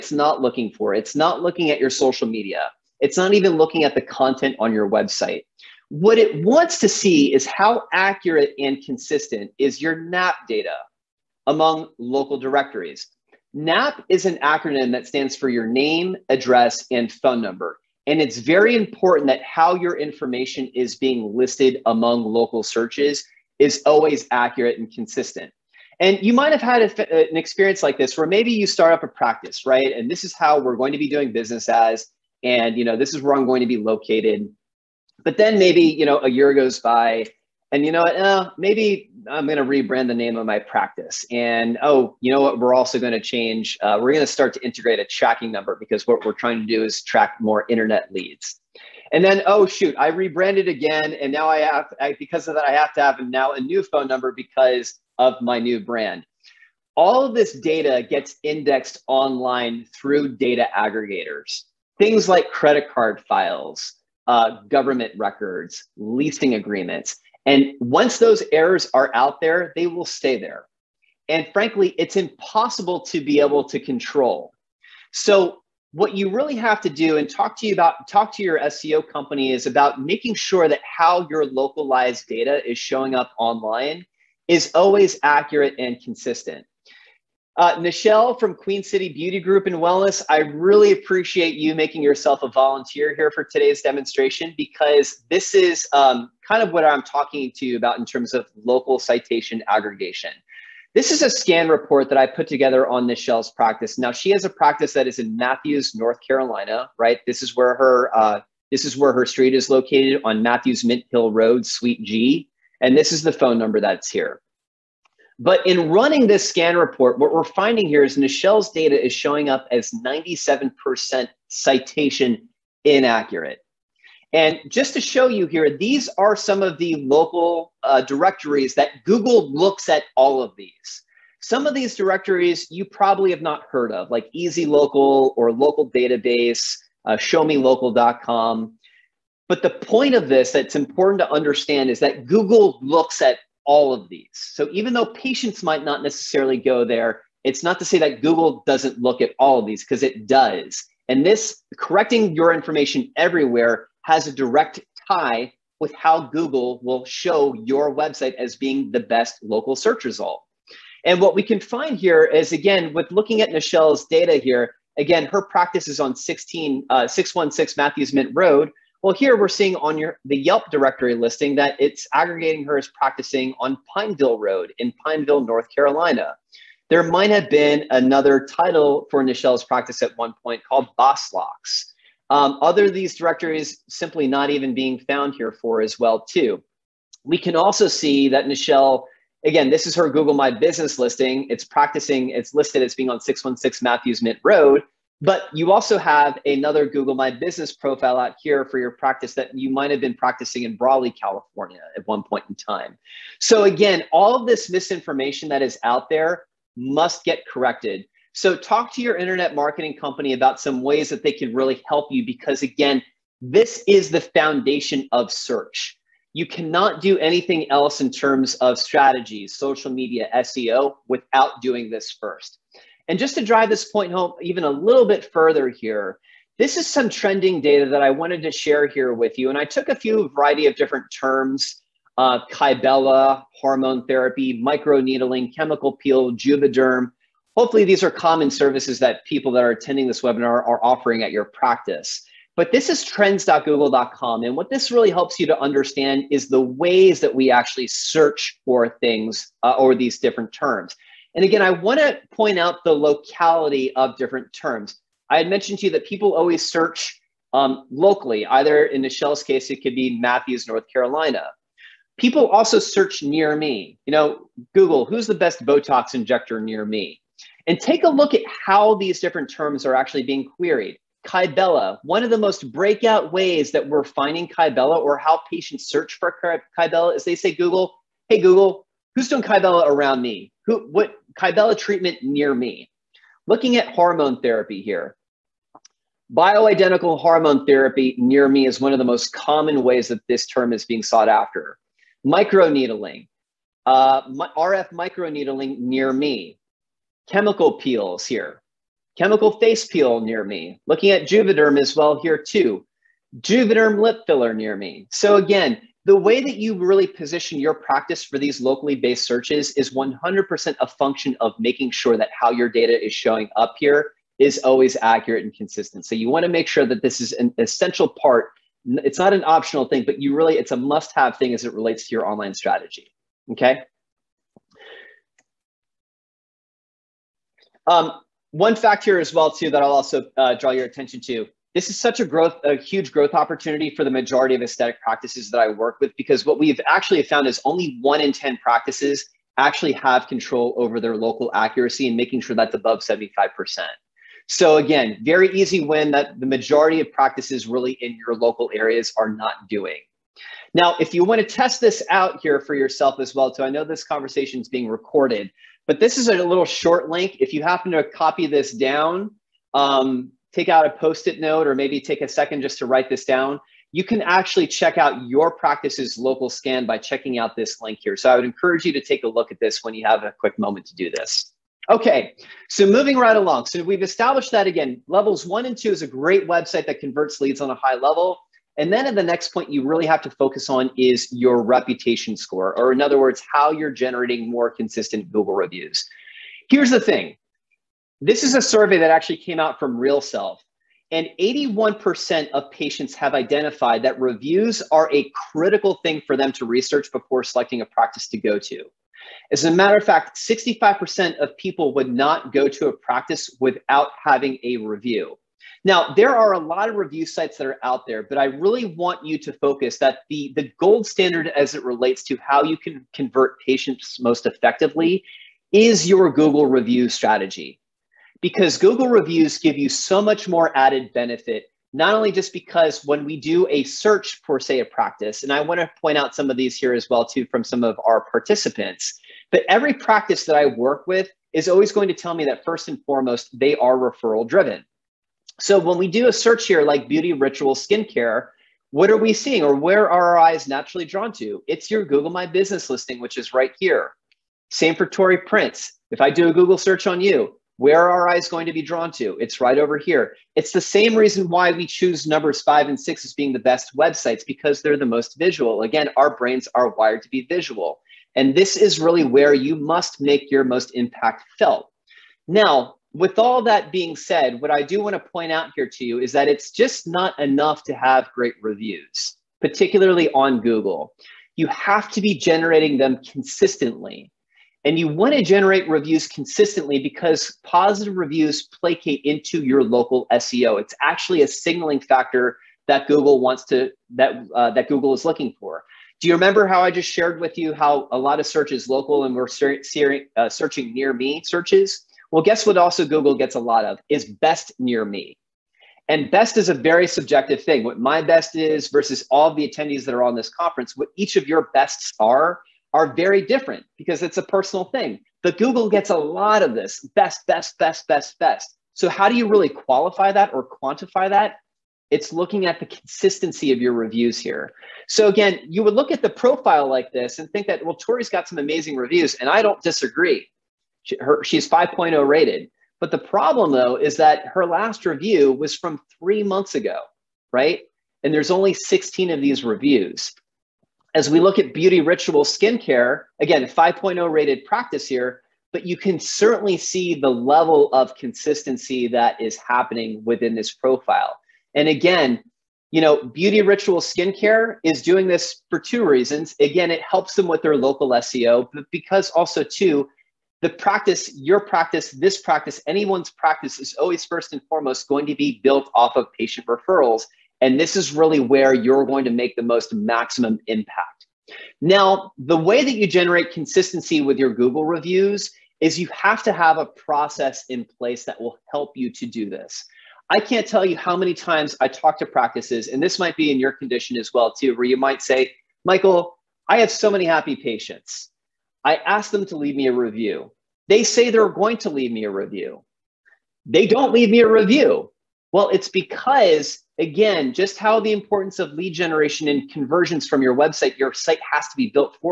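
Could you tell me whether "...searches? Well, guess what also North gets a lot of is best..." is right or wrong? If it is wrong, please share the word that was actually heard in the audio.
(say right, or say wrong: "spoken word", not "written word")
wrong: "Google", not "North".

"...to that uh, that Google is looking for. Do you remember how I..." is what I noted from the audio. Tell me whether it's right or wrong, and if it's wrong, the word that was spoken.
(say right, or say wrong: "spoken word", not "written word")
right.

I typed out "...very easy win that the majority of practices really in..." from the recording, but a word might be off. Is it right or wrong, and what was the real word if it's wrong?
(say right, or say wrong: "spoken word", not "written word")
right.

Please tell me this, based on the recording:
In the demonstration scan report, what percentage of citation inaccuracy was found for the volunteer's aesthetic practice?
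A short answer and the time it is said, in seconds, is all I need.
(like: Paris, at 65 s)
97%, at 120 s.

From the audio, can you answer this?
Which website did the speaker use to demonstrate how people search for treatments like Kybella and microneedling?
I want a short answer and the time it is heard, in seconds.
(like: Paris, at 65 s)
trends.google.com, at 243 s.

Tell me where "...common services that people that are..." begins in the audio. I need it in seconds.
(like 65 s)
238 s.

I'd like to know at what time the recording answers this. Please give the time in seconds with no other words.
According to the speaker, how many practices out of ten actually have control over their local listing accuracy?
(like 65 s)
338 s.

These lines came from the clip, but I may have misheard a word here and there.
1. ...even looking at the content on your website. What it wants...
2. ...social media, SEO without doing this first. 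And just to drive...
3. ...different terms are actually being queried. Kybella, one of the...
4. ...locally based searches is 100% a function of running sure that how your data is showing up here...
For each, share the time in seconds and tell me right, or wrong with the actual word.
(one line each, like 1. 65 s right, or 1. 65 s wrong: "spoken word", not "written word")
1. 3 s right
2. 219 s right
3. 269 s right
4. 308 s wrong: "making", not "running".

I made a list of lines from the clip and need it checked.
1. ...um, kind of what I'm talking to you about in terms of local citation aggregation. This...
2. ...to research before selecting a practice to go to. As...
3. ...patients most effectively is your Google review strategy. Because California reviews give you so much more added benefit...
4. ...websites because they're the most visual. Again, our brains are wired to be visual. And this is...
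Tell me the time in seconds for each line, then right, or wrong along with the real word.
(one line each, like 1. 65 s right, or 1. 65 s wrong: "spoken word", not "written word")
1. 95 s right
2. 396 s right
3. 413 s wrong: "Google", not "California"
4. 453 s right.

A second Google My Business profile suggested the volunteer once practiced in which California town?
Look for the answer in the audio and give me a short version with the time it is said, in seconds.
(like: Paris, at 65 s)
Brawley, at 200 s.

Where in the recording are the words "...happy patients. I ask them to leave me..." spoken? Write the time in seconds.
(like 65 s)
577 s.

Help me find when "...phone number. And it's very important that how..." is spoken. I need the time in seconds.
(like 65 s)
17 s.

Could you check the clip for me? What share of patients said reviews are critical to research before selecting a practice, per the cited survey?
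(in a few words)
81%.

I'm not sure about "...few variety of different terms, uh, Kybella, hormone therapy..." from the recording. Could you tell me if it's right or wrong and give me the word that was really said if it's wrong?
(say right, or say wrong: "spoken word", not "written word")
right.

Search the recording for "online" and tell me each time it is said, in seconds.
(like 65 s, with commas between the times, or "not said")
59 s, 83 s, 322 s.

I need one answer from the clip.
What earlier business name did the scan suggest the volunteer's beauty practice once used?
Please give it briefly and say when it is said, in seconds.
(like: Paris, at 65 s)
Boss Locks, at 180 s.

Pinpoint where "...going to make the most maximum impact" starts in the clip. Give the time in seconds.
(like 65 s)
559 s.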